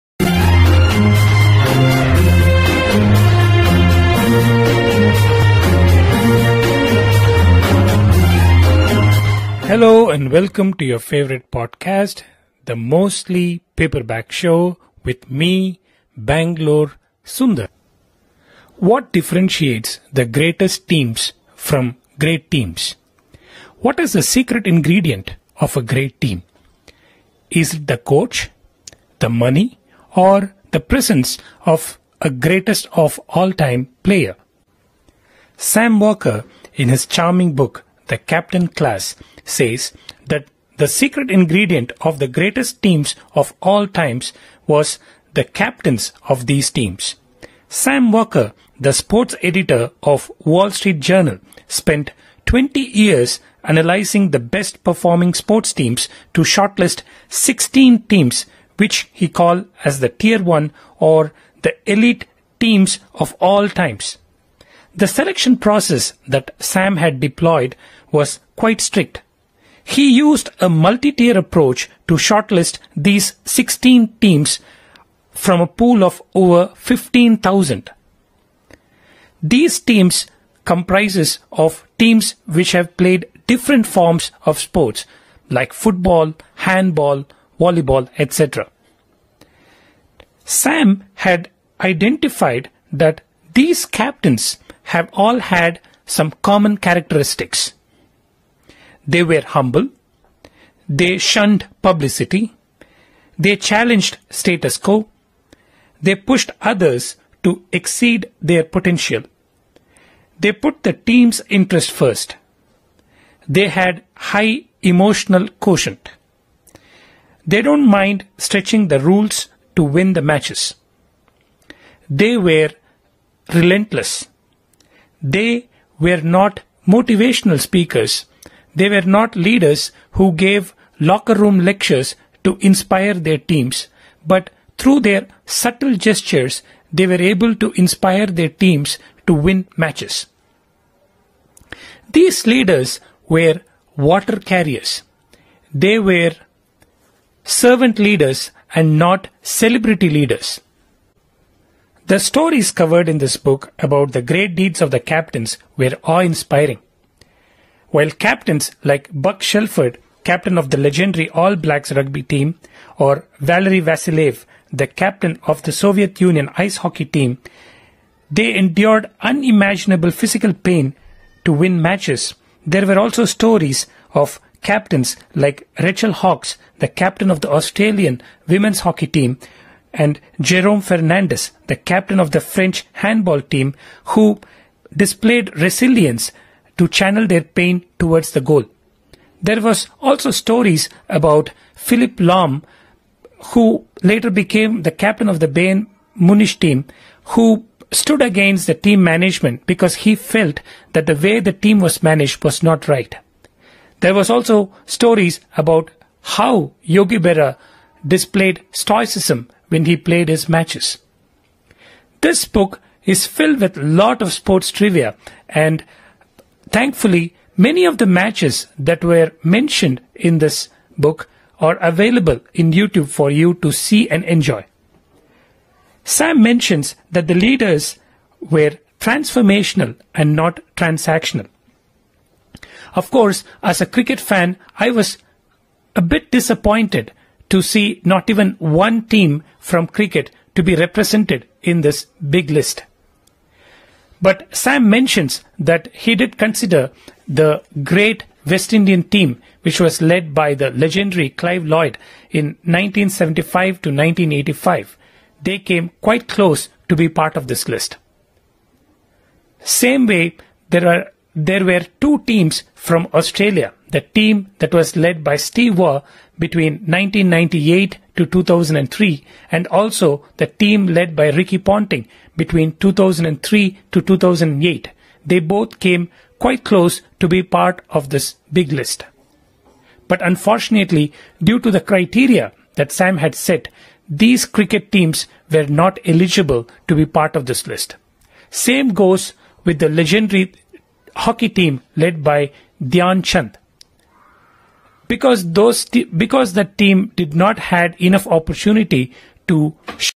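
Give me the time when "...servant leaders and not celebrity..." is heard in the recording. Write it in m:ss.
2:27.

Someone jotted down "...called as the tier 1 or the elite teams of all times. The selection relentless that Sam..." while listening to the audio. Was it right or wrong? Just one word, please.
wrong.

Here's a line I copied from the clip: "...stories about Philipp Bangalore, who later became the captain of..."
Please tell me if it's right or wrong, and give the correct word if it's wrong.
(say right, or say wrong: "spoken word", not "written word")
wrong: "Lahm", not "Bangalore".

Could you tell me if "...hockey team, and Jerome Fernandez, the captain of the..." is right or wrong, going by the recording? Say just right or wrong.
right.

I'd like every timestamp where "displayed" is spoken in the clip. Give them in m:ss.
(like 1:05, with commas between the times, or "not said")
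3:04, 3:28.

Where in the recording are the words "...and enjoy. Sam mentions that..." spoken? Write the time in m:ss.
3:44.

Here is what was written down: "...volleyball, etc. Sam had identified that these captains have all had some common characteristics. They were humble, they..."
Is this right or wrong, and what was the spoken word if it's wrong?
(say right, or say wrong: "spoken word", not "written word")
right.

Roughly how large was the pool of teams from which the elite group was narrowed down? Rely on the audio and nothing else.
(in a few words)
Over 15,000.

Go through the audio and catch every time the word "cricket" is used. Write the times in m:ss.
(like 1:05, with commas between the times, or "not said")
3:53, 3:59, 4:44.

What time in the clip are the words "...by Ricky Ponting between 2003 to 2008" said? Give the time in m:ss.
4:31.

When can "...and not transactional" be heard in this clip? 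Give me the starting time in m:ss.
3:50.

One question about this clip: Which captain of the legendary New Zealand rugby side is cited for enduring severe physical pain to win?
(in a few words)
Buck Shelford.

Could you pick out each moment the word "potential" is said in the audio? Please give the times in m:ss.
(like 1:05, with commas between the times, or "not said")
1:48.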